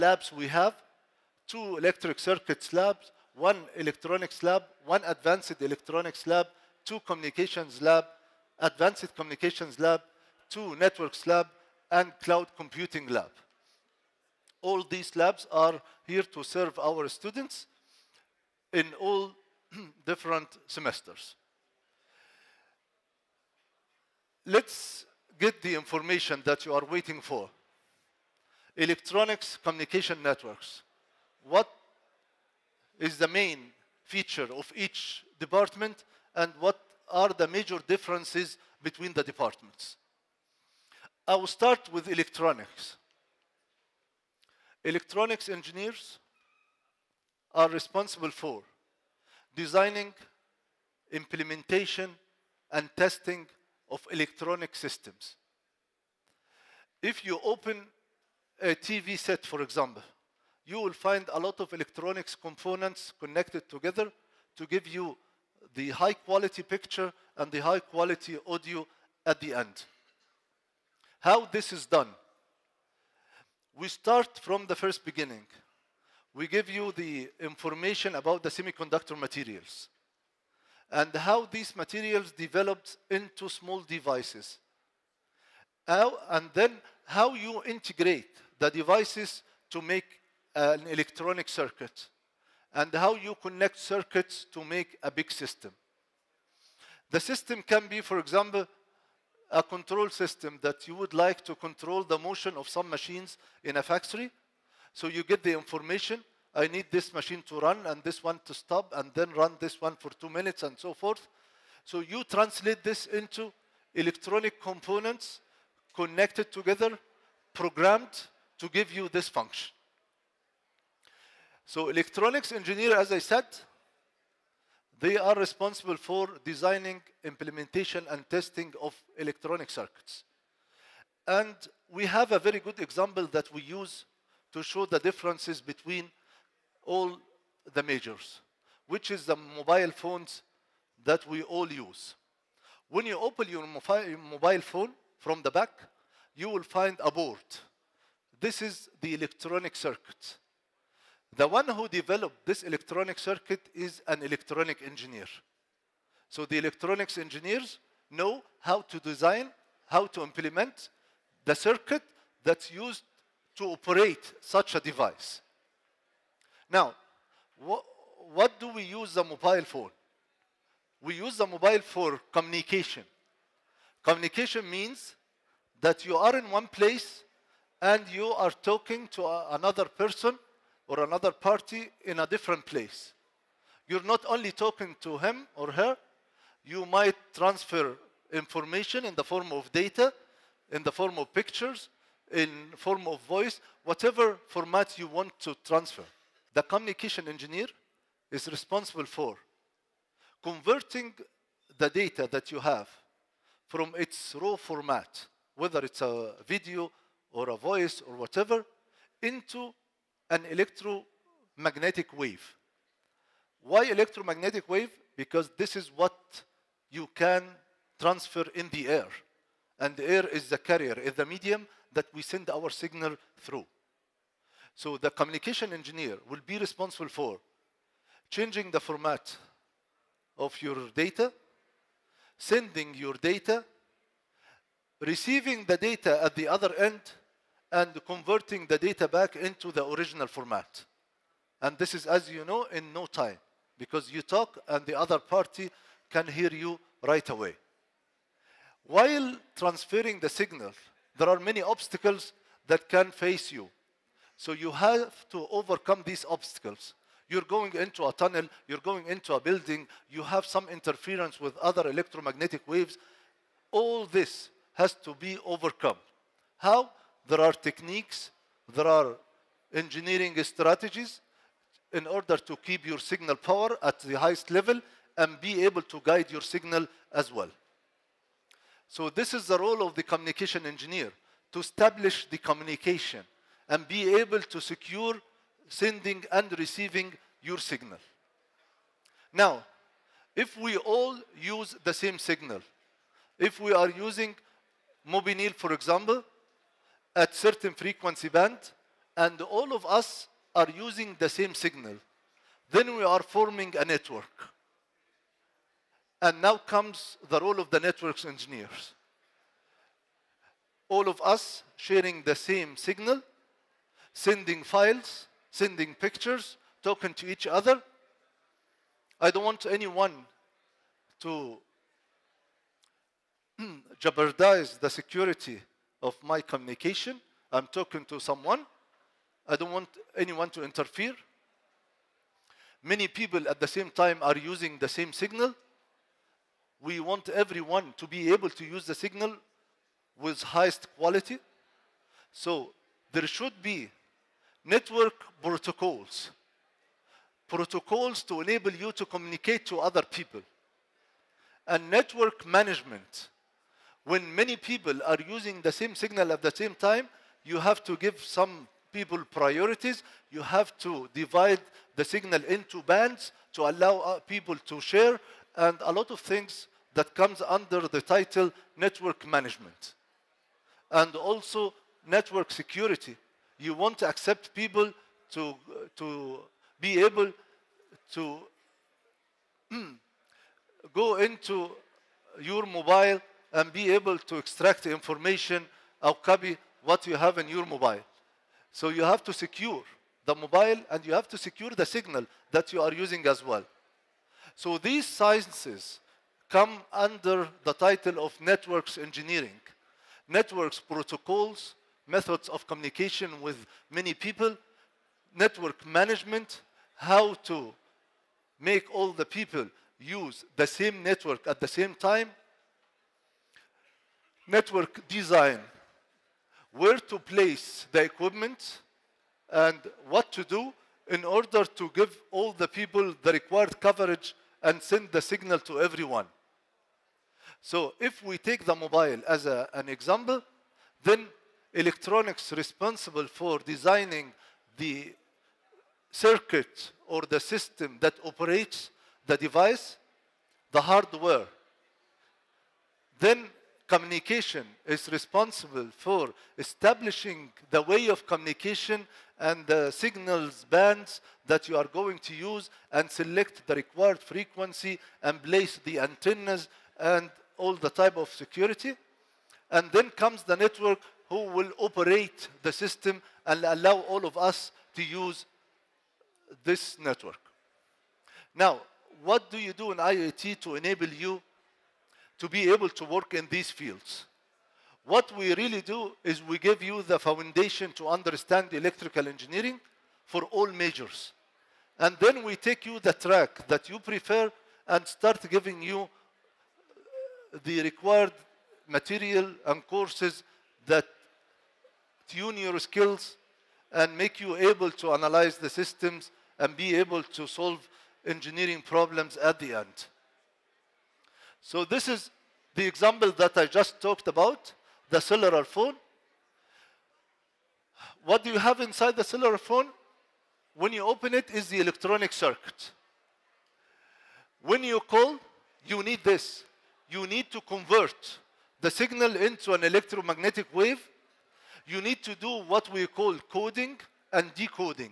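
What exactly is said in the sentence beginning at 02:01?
So electronics engineer, as I said, they are responsible for designing, implementation, and testing of electronic circuits.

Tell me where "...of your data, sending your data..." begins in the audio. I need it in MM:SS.
03:50.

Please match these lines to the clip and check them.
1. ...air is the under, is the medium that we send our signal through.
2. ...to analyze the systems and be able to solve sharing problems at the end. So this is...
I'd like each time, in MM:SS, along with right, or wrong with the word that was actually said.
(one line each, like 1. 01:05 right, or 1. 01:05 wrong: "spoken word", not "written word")
1. 03:40 wrong: "carrier", not "under"
2. 08:14 wrong: "engineering", not "sharing".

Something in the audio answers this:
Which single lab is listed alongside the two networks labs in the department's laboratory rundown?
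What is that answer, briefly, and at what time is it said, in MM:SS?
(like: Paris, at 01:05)
Cloud computing lab, at 00:12.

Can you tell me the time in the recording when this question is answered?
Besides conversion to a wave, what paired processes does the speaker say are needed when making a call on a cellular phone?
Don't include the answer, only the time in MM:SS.
08:43.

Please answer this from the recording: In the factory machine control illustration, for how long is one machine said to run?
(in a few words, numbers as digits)
2 minutes.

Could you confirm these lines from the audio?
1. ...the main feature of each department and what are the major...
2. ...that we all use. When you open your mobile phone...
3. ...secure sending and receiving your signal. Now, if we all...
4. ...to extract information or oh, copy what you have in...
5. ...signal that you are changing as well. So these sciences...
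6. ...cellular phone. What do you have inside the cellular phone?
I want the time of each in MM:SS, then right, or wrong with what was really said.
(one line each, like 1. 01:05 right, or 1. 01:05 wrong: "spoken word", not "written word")
1. 00:33 right
2. 02:21 right
3. 04:44 right
4. 06:24 right
5. 06:31 wrong: "using", not "changing"
6. 08:25 right.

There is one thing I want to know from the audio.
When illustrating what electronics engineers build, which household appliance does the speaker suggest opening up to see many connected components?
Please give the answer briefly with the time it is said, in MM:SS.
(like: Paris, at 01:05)
TV set, at 00:58.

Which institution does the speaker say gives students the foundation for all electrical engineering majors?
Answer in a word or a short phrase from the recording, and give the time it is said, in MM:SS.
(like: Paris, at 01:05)
IET, at 07:49.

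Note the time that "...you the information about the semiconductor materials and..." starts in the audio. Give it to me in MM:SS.
01:16.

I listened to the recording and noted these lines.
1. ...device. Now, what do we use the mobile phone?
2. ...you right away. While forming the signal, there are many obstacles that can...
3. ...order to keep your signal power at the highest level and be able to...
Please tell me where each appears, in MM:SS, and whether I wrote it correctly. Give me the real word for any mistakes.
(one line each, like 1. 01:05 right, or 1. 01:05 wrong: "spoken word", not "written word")
1. 02:44 right
2. 04:06 wrong: "transferring", not "forming"
3. 04:32 right.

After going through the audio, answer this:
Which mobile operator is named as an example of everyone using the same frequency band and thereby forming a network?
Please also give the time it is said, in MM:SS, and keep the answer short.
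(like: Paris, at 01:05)
Mobinil, at 04:55.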